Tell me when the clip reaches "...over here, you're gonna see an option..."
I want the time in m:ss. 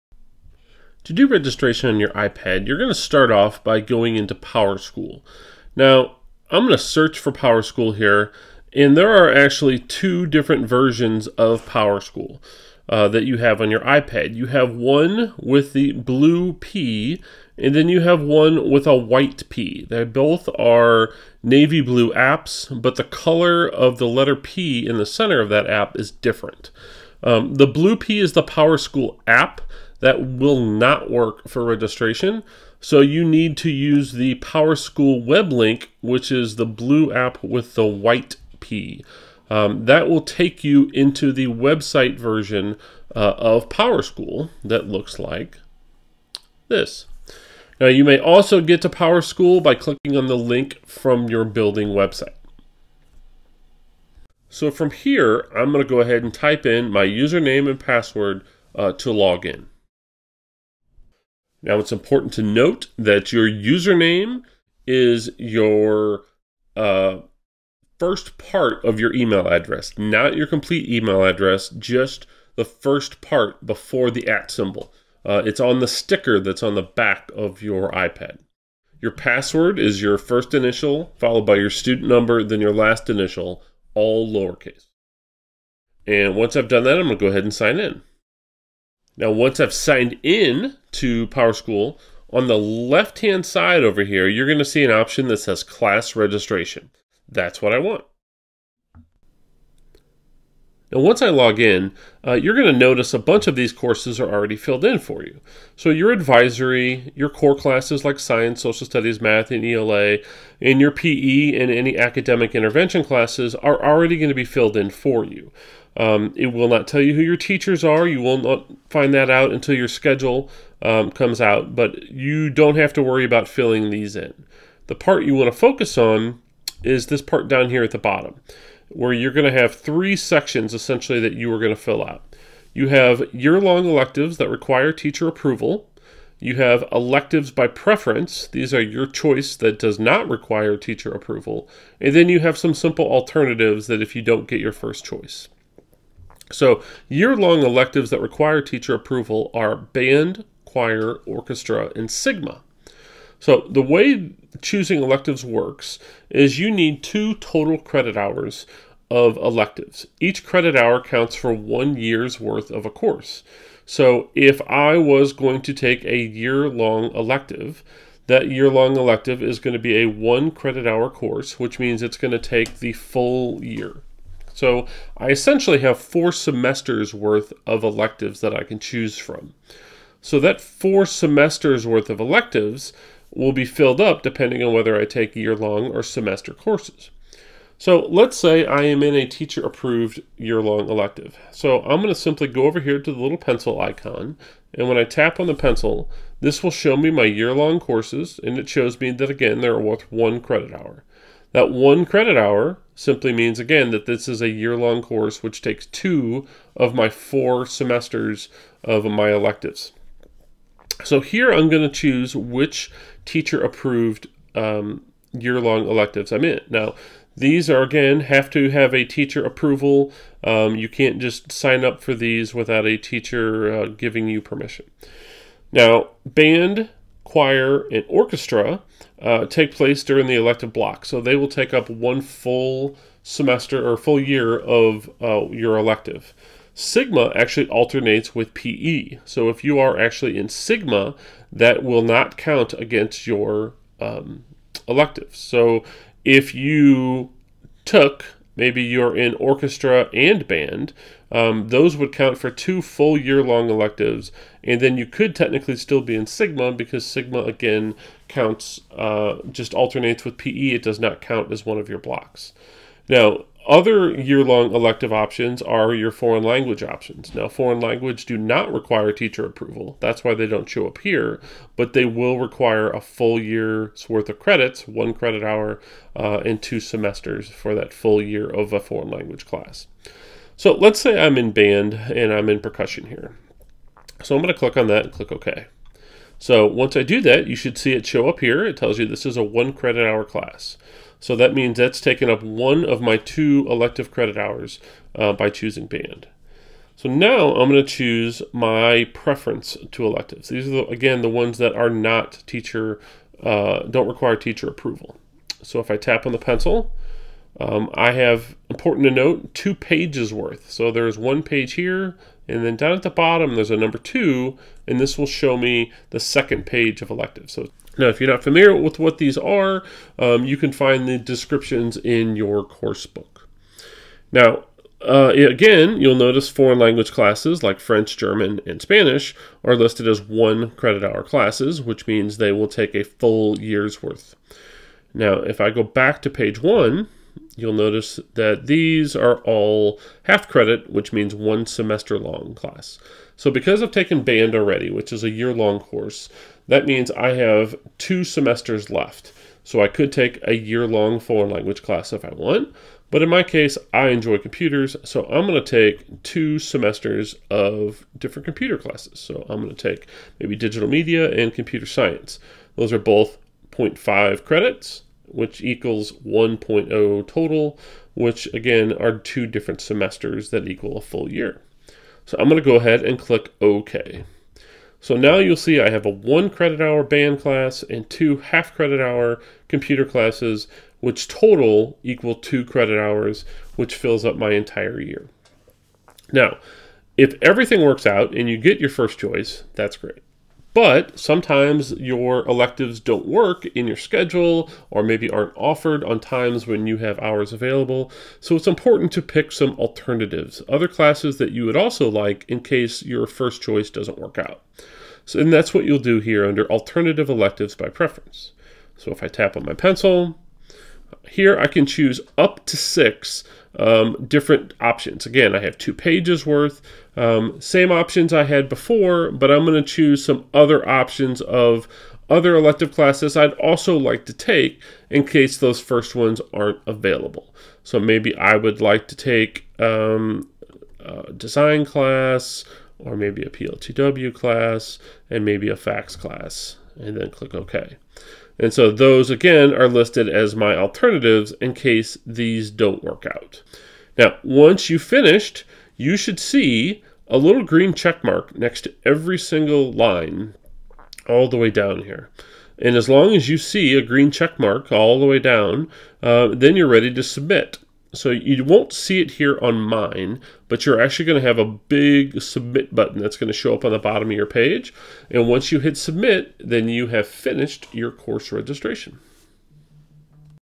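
1:33.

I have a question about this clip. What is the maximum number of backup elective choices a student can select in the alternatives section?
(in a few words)
6.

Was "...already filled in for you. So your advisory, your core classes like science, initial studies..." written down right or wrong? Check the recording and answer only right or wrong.
wrong.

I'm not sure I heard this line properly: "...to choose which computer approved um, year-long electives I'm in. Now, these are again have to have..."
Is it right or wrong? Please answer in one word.
wrong.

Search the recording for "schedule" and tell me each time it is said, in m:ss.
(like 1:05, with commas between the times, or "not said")
1:59, 6:33.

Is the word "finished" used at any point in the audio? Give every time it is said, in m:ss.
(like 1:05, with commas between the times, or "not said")
7:24, 7:47.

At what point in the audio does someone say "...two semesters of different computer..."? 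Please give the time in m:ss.
5:56.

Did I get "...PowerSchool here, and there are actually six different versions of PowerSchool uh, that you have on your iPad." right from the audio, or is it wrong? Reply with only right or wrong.
wrong.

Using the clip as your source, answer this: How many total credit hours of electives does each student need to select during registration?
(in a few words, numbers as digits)
2.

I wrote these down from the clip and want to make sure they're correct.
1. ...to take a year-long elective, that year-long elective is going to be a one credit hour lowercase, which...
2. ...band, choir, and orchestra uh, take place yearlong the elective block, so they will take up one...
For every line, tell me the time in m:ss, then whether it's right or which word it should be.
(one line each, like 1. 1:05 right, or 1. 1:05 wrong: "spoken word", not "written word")
1. 2:45 wrong: "course", not "lowercase"
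2. 3:46 wrong: "during", not "yearlong".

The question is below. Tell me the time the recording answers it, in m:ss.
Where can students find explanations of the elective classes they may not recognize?
5:22.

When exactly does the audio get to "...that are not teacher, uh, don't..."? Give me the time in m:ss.
5:01.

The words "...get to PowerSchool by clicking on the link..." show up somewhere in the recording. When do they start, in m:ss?
0:48.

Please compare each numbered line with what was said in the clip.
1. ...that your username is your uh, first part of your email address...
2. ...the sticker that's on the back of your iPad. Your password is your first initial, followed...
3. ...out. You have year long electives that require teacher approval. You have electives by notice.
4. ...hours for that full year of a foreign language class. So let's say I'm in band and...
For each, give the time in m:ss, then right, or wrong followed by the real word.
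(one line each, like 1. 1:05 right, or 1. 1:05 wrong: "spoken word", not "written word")
1. 1:02 right
2. 1:15 right
3. 2:12 wrong: "preference", not "notice"
4. 4:36 wrong: "semesters", not "hours".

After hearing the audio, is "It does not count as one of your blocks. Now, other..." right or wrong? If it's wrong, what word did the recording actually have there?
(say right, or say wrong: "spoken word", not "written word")
right.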